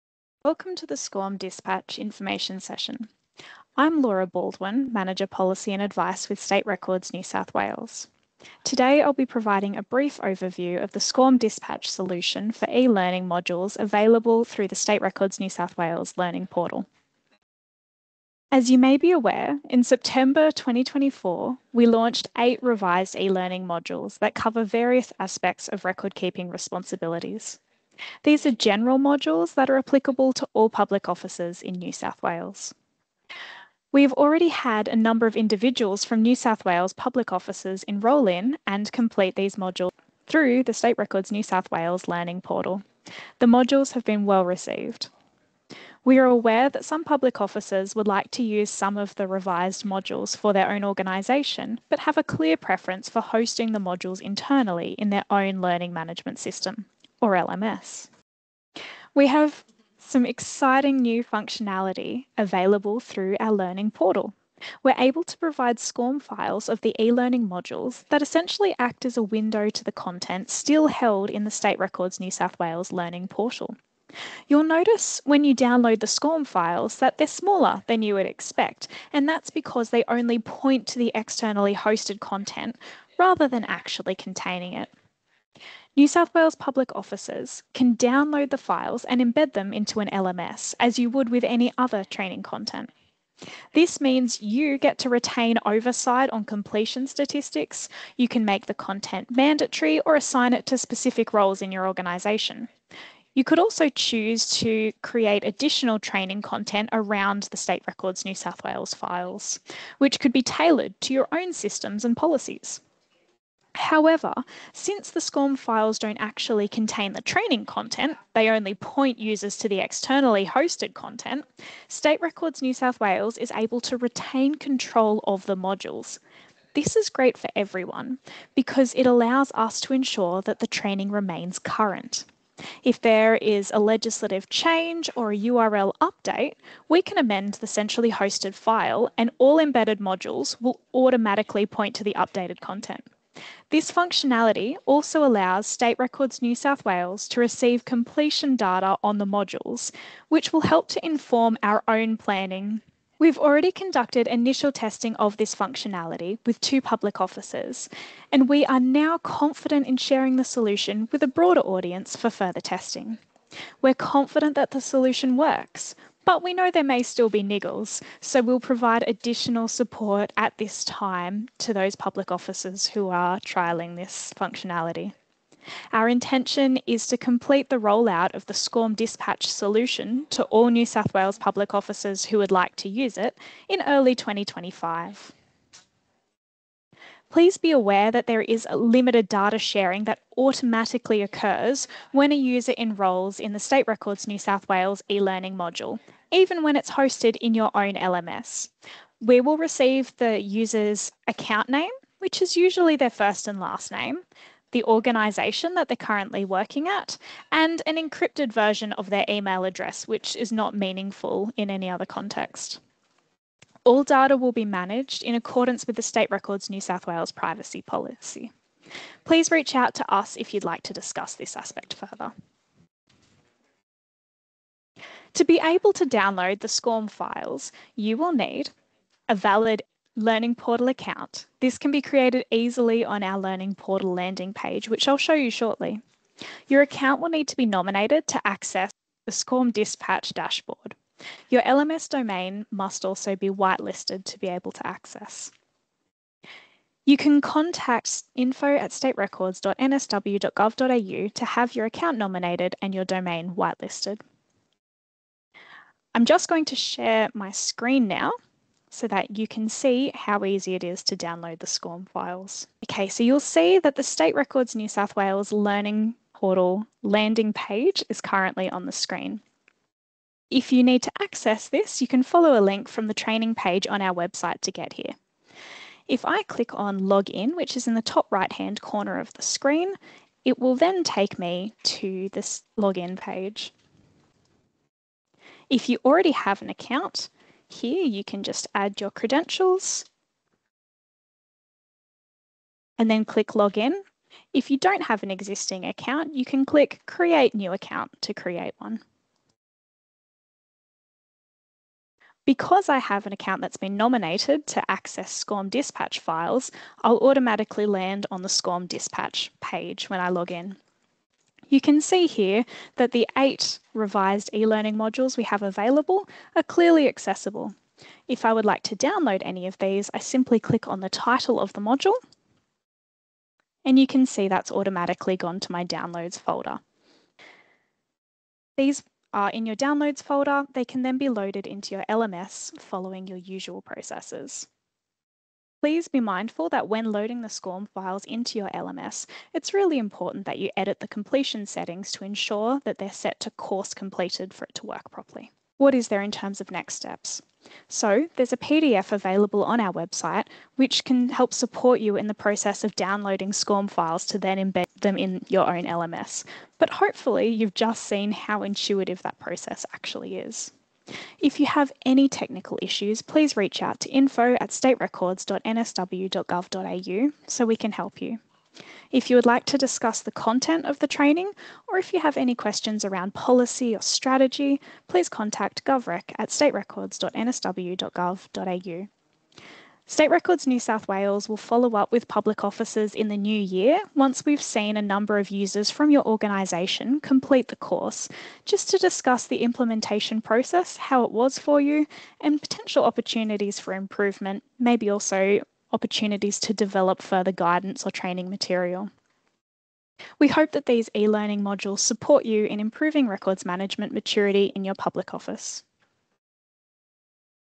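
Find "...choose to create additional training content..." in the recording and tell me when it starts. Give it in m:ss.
1:43.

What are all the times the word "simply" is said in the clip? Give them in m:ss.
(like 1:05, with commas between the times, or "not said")
5:20.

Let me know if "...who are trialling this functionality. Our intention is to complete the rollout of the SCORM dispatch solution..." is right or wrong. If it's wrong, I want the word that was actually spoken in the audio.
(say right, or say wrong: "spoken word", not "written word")
right.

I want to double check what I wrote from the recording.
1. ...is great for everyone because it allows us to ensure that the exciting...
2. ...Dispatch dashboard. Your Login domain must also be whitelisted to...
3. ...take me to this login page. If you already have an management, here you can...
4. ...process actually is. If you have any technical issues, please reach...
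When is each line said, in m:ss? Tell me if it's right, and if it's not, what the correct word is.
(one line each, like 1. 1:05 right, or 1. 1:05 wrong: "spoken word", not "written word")
1. 2:06 wrong: "training", not "exciting"
2. 3:59 wrong: "LMS", not "Login"
3. 4:41 wrong: "account", not "management"
4. 5:59 right.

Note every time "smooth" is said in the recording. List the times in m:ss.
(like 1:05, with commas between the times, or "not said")
not said.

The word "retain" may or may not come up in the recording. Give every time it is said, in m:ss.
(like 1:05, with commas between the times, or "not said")
1:35, 2:03.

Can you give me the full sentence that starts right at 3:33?
All data will be managed in accordance with the State Records New South Wales privacy policy.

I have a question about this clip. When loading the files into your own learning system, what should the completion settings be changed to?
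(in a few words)
course completed.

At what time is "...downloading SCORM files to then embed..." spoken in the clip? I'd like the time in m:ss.
5:52.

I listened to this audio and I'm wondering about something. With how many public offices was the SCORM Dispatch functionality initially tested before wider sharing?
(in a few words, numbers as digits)
2.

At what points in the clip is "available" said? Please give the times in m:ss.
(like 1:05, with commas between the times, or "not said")
0:13, 1:02, 5:15, 5:49.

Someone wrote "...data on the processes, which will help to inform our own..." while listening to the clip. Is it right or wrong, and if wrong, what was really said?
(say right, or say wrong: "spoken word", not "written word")
wrong: "modules", not "processes".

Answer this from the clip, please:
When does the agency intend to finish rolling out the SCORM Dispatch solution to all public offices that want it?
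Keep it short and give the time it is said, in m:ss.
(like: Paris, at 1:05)
early 2025, at 3:03.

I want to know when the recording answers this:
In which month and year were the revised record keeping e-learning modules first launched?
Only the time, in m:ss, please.
0:19.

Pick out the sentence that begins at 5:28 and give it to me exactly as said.
These are uh, in your downloads folder, they can then be loaded into your LMS following your usual processes.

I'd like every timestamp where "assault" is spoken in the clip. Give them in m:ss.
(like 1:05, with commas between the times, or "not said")
not said.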